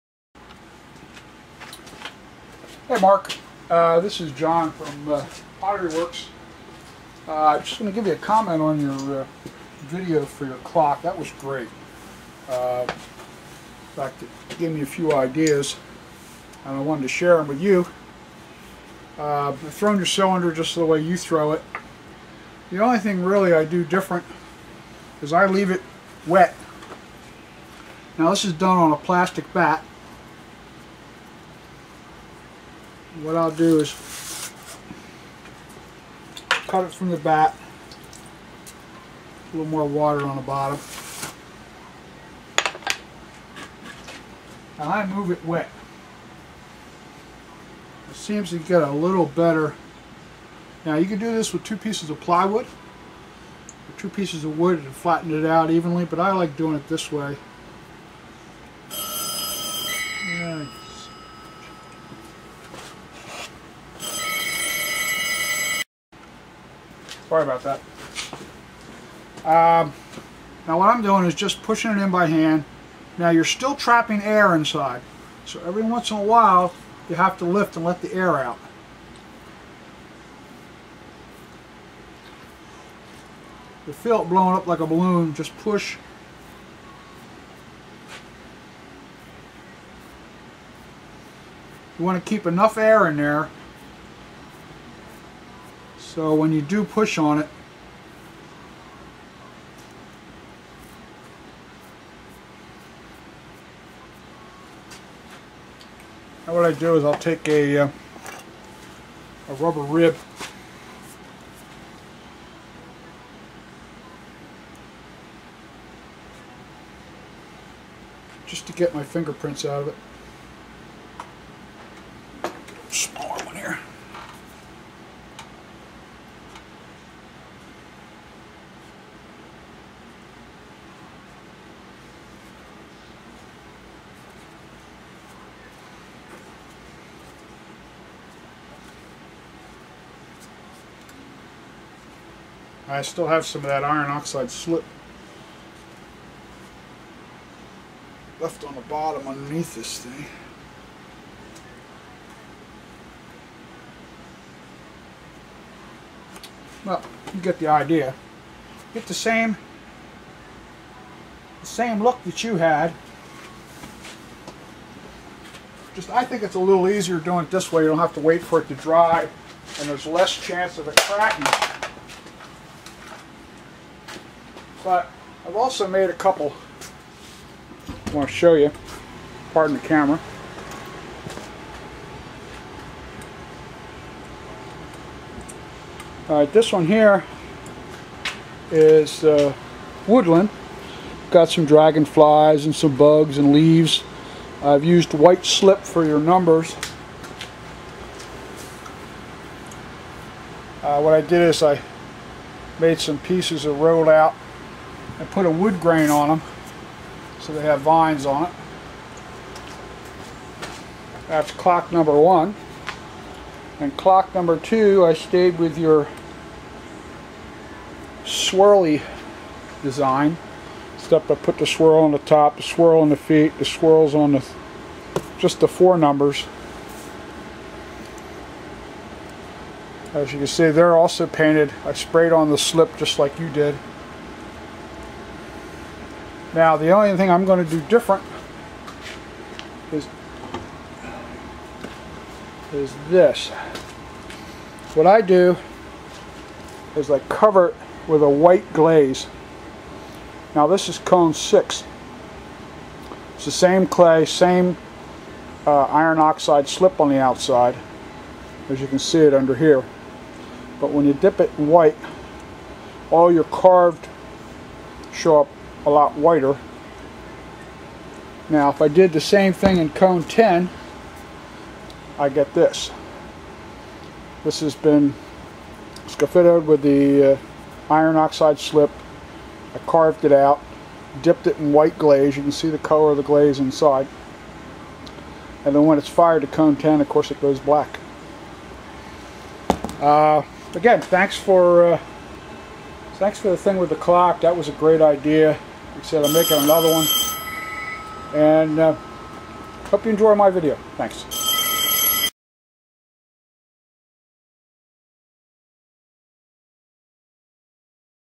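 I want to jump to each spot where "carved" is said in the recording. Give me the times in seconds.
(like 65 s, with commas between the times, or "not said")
263 s, 279 s.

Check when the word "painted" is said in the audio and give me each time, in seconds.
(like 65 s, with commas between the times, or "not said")
231 s.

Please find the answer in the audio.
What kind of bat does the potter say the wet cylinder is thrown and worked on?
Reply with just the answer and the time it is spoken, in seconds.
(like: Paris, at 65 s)
plastic bat, at 28 s.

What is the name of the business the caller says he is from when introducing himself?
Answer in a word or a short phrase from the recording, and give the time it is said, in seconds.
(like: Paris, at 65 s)
Pottery Works, at 5 s.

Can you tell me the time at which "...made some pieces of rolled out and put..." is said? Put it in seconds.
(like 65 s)
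202 s.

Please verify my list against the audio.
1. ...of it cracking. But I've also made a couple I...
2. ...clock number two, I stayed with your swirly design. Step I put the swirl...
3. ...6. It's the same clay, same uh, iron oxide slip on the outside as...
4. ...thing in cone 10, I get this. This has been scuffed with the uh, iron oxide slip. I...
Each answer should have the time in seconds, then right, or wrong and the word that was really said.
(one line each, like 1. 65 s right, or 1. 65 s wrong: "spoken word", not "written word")
1. 170 s right
2. 213 s right
3. 251 s right
4. 269 s right.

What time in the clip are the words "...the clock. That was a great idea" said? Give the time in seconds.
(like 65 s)
293 s.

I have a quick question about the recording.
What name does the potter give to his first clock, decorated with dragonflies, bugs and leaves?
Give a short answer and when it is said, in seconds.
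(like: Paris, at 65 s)
woodland, at 190 s.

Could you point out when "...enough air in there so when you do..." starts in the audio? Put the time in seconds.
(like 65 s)
92 s.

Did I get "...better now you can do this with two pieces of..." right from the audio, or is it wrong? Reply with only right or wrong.
right.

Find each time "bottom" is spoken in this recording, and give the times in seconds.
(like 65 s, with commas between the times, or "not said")
40 s, 148 s.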